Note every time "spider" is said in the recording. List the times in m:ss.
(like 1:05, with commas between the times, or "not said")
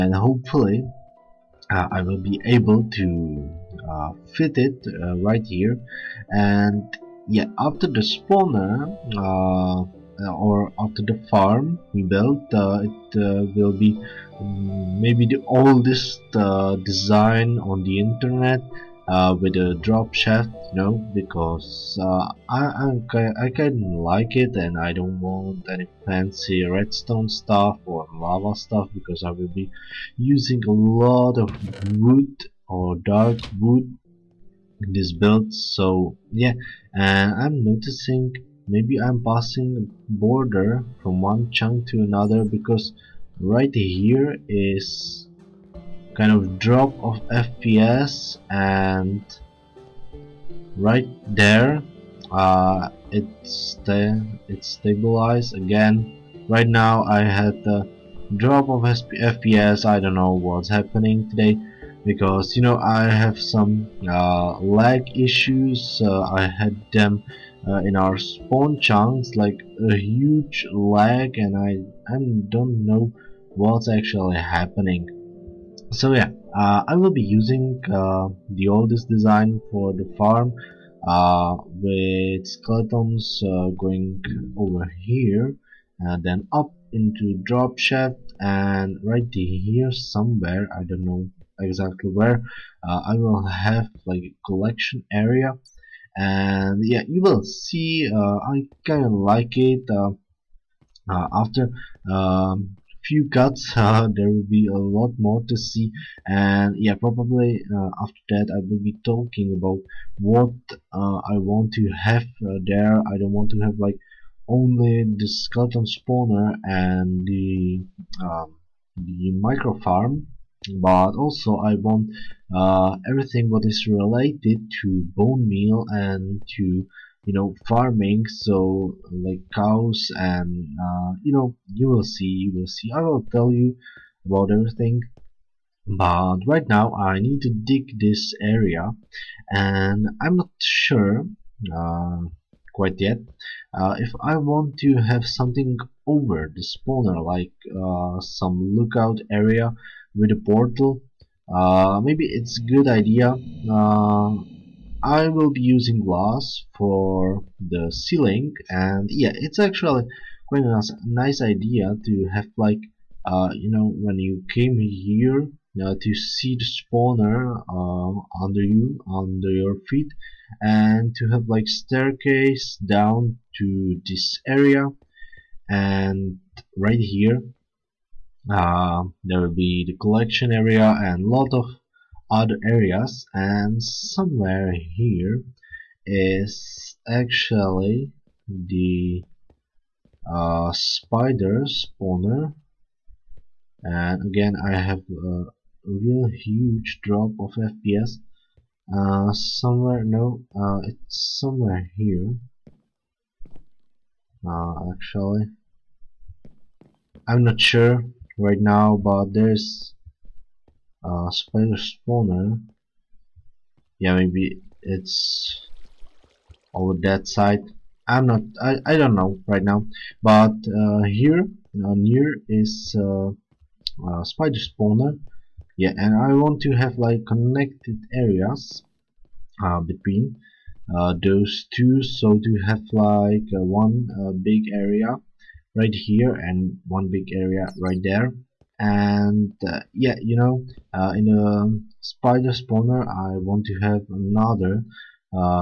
3:10, 3:31, 3:44, 4:02.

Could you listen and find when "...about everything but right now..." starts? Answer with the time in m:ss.
2:14.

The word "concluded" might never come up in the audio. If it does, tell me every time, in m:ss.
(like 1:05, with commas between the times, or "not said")
not said.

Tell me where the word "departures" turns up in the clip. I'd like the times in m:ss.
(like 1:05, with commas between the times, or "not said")
not said.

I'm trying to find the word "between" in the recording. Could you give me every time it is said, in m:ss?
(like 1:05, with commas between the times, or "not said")
3:49.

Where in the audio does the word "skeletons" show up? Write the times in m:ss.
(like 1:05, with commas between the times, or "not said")
1:22, 1:55.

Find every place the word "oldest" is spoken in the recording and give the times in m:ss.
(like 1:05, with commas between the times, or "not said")
0:15, 1:18.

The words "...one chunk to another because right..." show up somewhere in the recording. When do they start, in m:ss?
0:41.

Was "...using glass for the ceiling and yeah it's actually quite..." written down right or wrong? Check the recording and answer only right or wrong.
right.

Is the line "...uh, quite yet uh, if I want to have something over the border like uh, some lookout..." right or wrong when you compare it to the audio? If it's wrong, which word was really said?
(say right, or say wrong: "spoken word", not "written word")
wrong: "spawner", not "border".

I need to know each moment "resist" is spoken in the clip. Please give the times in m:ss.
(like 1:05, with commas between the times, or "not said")
not said.